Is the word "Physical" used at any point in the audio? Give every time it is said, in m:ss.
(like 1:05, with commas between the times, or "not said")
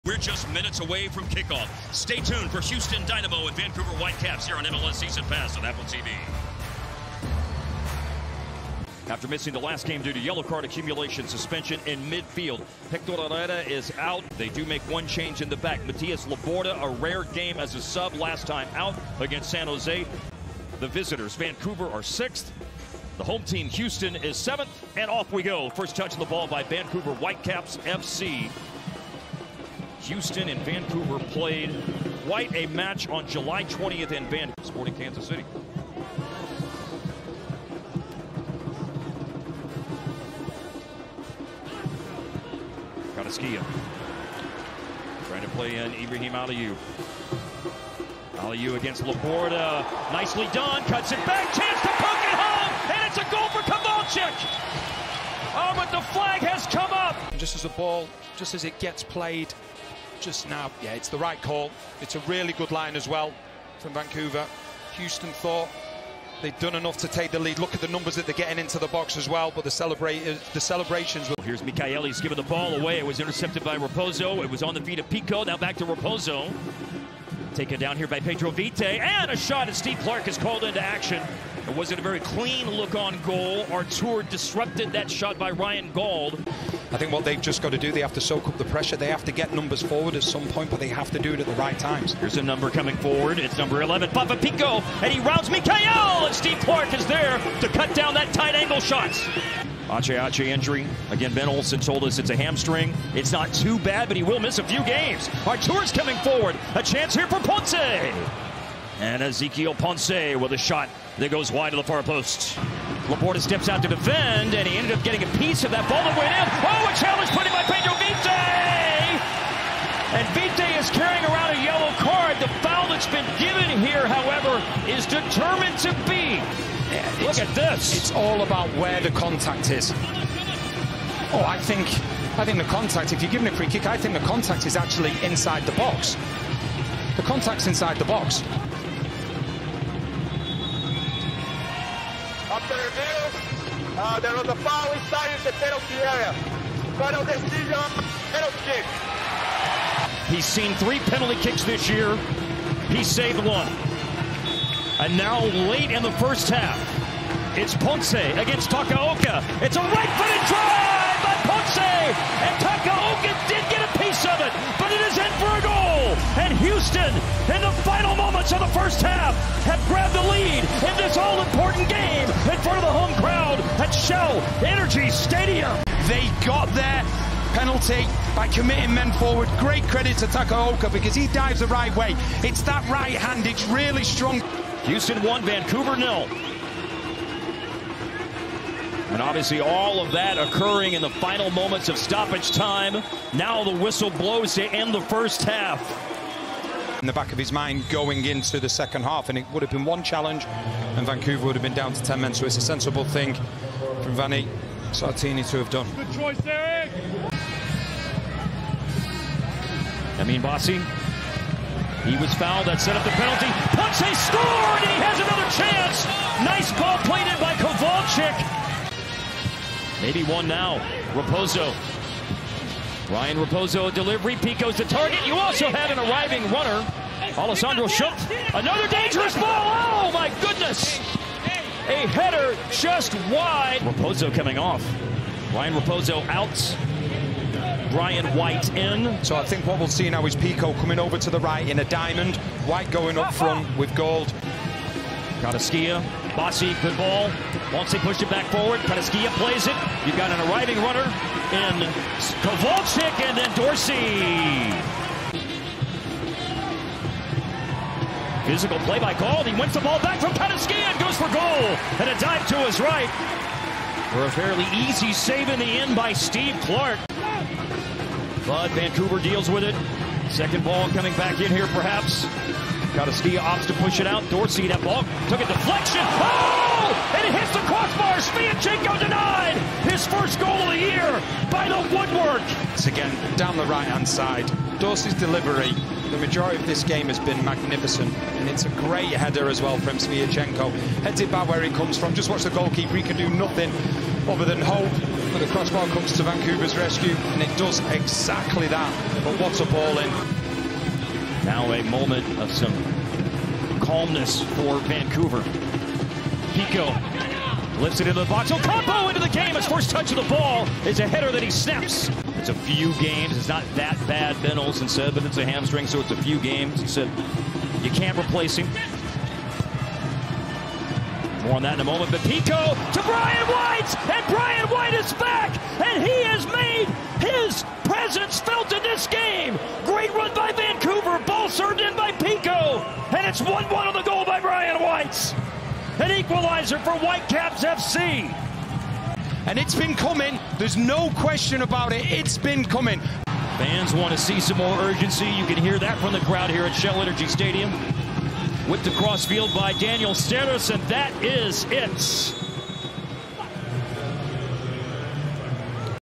4:18.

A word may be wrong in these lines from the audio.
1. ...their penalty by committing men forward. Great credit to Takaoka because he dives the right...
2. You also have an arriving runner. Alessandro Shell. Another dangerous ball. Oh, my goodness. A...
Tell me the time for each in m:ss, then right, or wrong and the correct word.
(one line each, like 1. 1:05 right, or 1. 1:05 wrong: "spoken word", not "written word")
1. 2:56 right
2. 3:45 wrong: "Schöpf", not "Shell".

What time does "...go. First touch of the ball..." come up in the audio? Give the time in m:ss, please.
0:25.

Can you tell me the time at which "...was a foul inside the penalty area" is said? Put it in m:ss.
2:24.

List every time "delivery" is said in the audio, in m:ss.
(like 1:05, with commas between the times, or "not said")
3:43, 4:45.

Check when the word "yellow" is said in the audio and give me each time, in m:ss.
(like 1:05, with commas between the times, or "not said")
0:10, 2:01.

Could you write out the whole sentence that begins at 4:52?
He can do nothing other than hope.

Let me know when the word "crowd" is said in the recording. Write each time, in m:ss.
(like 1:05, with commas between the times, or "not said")
2:53, 5:46.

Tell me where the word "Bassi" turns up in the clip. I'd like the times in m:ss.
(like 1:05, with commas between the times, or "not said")
3:30, 4:06.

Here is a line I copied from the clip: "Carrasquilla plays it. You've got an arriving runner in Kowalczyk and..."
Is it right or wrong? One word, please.
right.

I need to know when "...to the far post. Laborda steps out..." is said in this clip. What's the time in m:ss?
1:51.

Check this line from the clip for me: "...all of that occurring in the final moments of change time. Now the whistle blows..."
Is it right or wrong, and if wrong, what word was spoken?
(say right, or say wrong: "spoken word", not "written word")
wrong: "stoppage", not "change".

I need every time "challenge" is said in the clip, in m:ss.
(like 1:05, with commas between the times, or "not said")
1:56, 3:20.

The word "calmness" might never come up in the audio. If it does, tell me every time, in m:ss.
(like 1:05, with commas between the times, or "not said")
5:03.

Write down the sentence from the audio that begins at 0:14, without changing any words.
They do make one change in the back.